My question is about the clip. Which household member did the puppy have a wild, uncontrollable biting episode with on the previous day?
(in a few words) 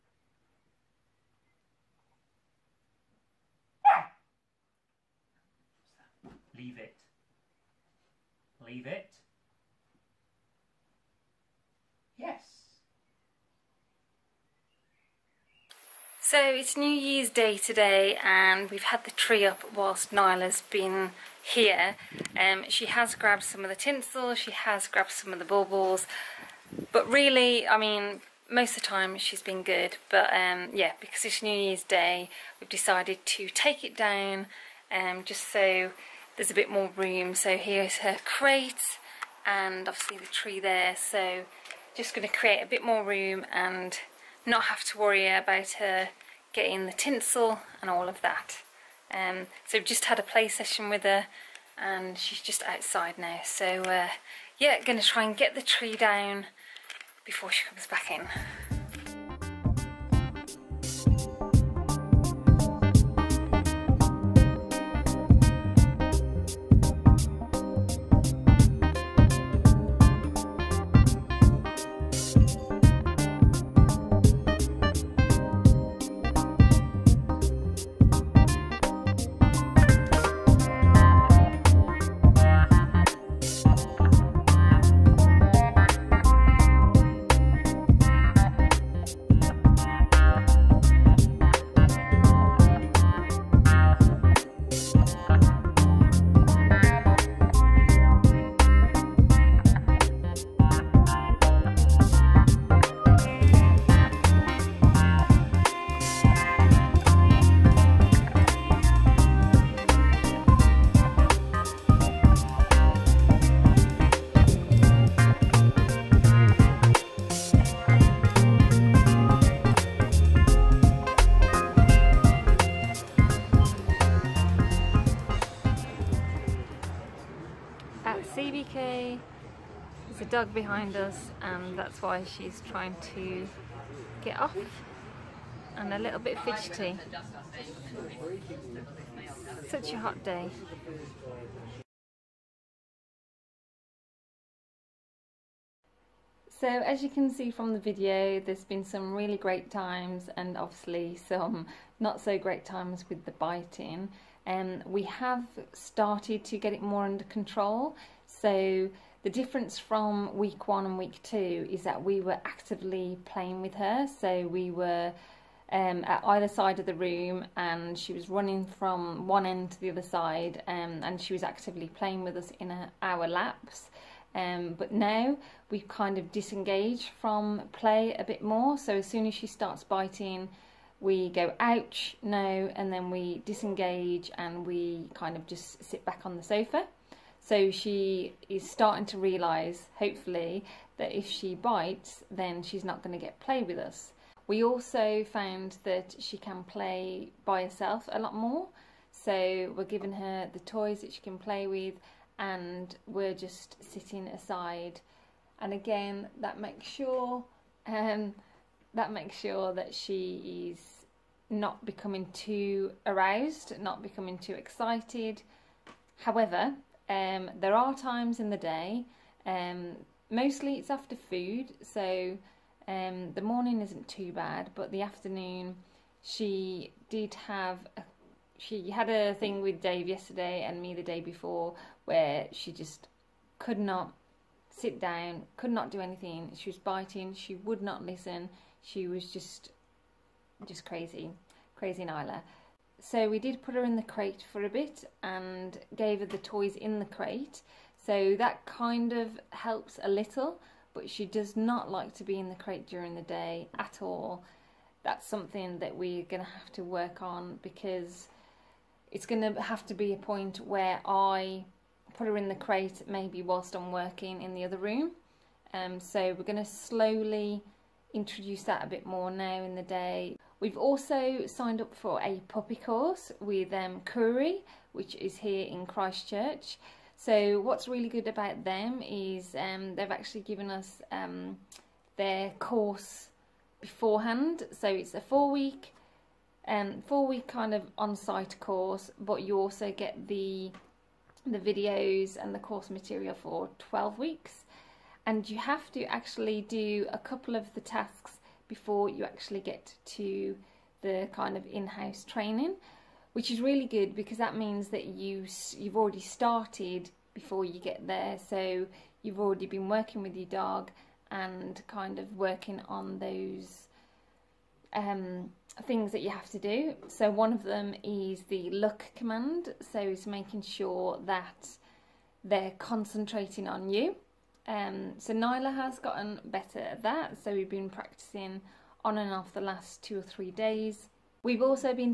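Dave.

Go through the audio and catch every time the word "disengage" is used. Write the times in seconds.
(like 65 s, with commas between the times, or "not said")
176 s, 183 s.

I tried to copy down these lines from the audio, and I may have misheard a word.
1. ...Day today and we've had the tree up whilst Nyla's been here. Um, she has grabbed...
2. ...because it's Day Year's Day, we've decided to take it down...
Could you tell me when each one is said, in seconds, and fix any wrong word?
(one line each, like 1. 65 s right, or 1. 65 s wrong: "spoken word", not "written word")
1. 17 s right
2. 31 s wrong: "New", not "Day".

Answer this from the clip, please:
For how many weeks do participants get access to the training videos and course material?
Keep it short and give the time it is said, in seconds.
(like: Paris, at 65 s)
12, at 293 s.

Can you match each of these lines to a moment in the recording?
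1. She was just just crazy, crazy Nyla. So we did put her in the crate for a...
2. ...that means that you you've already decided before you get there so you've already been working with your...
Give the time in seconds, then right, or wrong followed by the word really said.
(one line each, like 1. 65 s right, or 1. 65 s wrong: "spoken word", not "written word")
1. 238 s right
2. 304 s wrong: "started", not "decided".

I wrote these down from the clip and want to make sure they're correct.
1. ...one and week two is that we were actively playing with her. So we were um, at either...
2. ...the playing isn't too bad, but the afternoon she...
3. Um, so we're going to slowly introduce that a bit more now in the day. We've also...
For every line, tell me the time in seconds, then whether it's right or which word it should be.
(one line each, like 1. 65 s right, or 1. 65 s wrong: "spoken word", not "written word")
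1. 160 s right
2. 223 s wrong: "morning", not "playing"
3. 265 s right.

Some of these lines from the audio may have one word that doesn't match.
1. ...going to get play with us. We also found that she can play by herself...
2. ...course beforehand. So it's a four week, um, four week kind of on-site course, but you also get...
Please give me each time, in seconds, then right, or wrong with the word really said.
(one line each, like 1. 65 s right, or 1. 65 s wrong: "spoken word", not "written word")
1. 193 s right
2. 282 s right.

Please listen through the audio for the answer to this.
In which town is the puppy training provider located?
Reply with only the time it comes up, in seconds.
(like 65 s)
275 s.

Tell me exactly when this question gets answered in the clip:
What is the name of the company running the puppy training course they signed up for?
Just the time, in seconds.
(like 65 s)
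274 s.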